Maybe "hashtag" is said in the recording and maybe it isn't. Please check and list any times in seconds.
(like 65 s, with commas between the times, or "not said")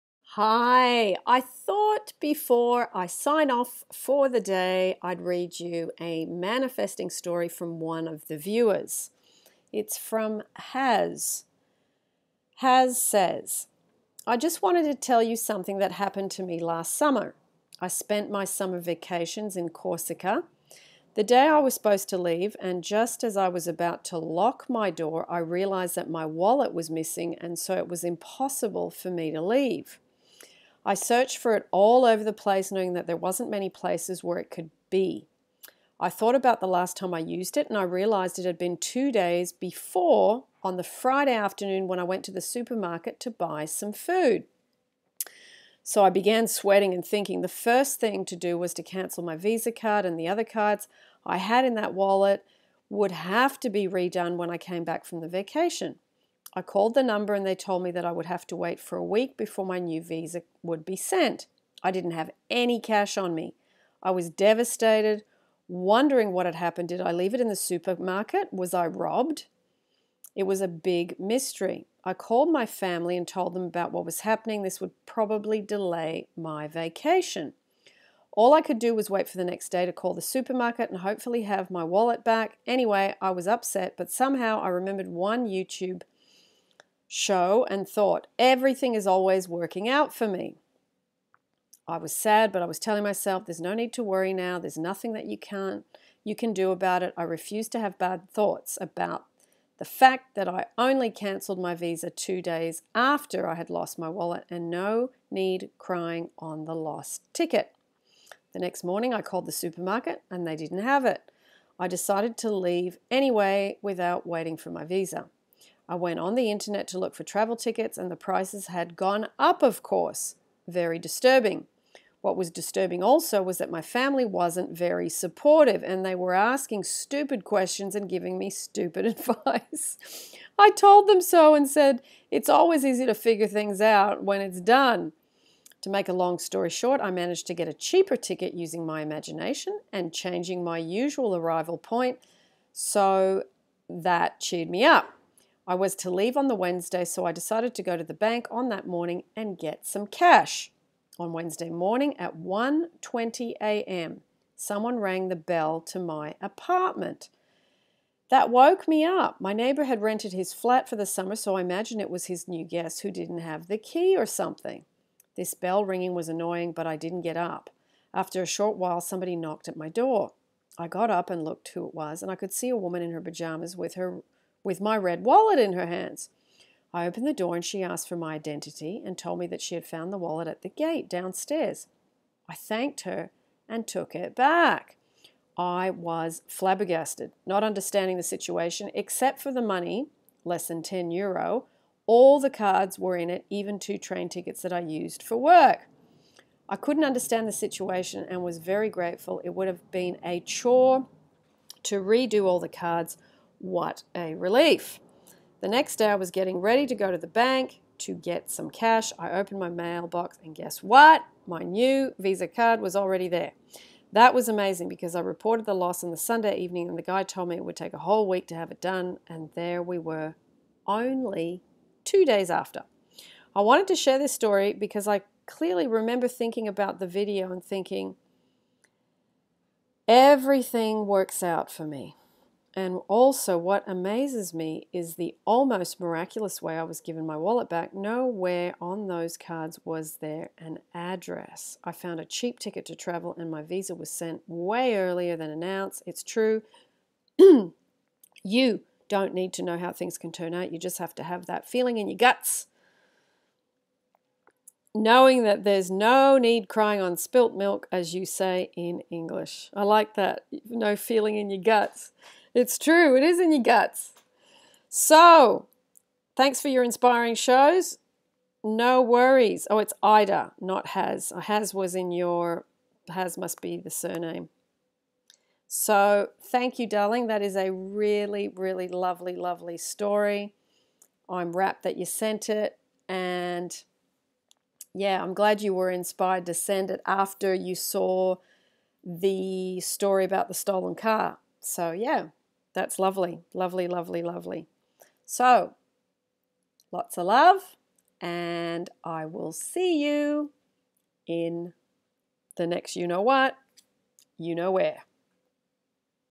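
not said.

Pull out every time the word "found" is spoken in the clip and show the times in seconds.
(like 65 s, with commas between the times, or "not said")
179 s, 241 s.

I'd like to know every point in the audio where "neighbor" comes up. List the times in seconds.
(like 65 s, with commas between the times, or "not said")
159 s.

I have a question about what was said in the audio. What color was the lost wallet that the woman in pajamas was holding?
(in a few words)
Red.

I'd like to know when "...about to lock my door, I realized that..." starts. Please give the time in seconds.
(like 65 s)
23 s.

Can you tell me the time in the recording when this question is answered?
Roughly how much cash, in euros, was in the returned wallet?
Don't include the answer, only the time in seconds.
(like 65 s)
190 s.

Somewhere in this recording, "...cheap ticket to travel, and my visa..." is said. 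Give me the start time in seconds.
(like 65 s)
242 s.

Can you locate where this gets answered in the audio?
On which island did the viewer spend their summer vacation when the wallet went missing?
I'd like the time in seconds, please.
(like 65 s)
19 s.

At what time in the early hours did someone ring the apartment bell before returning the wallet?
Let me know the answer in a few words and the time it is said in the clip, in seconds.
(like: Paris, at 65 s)
1:20 a.m., at 152 s.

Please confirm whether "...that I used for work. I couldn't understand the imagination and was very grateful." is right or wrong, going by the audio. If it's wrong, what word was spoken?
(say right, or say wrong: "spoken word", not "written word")
wrong: "situation", not "imagination".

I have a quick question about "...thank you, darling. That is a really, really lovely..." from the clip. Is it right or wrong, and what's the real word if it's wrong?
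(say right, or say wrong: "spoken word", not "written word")
right.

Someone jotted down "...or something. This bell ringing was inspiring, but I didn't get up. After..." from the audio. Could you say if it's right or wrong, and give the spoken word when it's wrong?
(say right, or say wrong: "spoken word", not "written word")
wrong: "annoying", not "inspiring".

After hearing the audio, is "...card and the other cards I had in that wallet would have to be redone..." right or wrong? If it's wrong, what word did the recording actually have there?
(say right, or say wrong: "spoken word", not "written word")
right.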